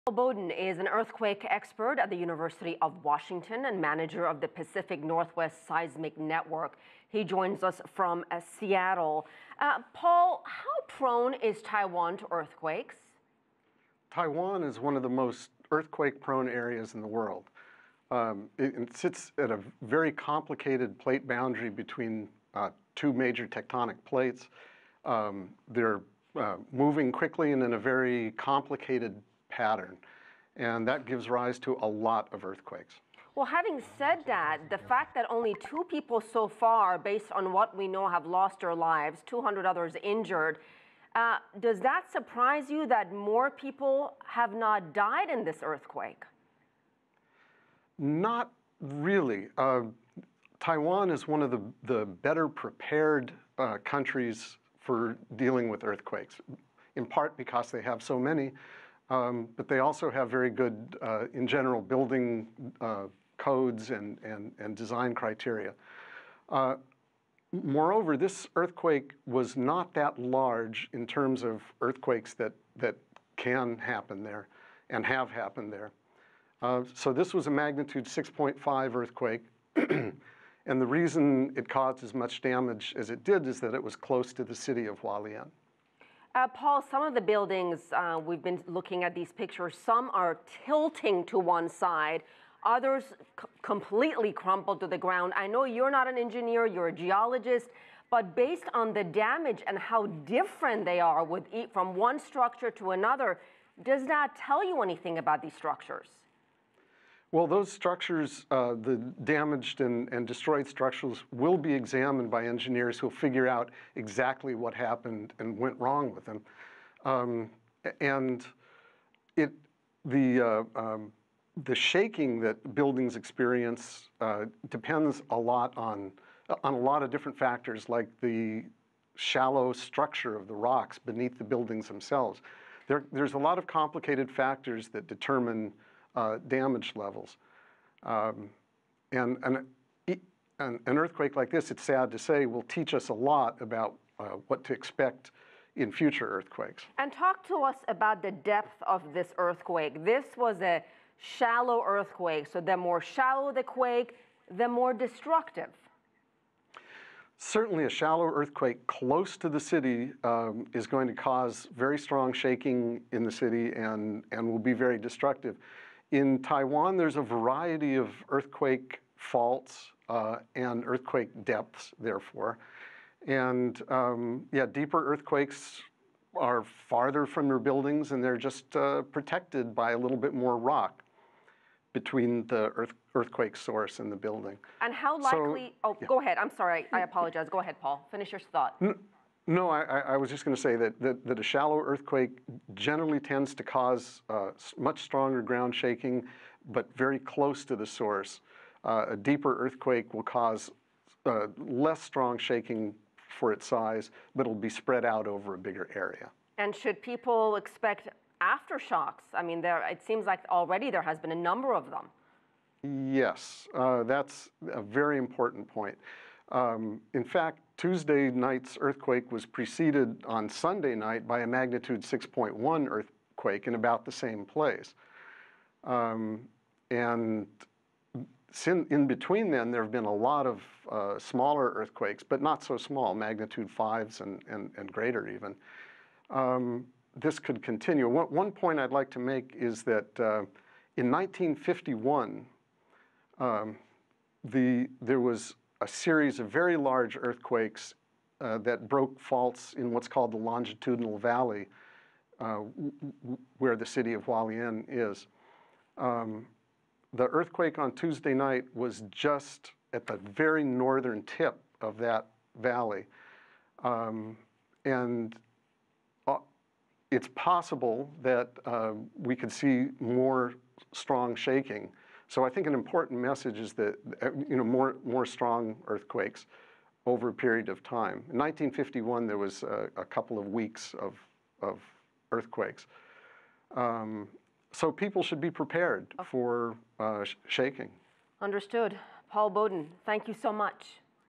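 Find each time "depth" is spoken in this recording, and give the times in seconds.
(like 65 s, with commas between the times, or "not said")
148 s, 171 s.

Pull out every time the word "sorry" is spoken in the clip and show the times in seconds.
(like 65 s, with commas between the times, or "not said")
186 s.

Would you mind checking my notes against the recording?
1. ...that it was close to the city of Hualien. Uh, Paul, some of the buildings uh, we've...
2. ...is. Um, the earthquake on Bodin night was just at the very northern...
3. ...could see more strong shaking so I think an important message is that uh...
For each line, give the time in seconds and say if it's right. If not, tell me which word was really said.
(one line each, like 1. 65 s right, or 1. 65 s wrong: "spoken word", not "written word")
1. 83 s right
2. 254 s wrong: "Tuesday", not "Bodin"
3. 269 s right.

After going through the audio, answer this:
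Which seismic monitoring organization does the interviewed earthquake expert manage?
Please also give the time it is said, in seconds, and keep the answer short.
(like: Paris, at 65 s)
Pacific Northwest Seismic Network, at 4 s.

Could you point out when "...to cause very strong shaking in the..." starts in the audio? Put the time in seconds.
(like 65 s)
161 s.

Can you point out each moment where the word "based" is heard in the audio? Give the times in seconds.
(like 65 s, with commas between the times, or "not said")
36 s, 98 s.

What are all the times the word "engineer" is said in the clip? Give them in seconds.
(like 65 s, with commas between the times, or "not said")
96 s, 112 s.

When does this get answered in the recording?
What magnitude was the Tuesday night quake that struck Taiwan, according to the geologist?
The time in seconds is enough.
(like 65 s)
77 s.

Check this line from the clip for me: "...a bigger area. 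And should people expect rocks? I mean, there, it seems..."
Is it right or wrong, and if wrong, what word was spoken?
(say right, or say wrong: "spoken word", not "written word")
wrong: "aftershocks", not "rocks".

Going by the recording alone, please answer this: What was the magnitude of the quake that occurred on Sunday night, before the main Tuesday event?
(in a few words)
6.1.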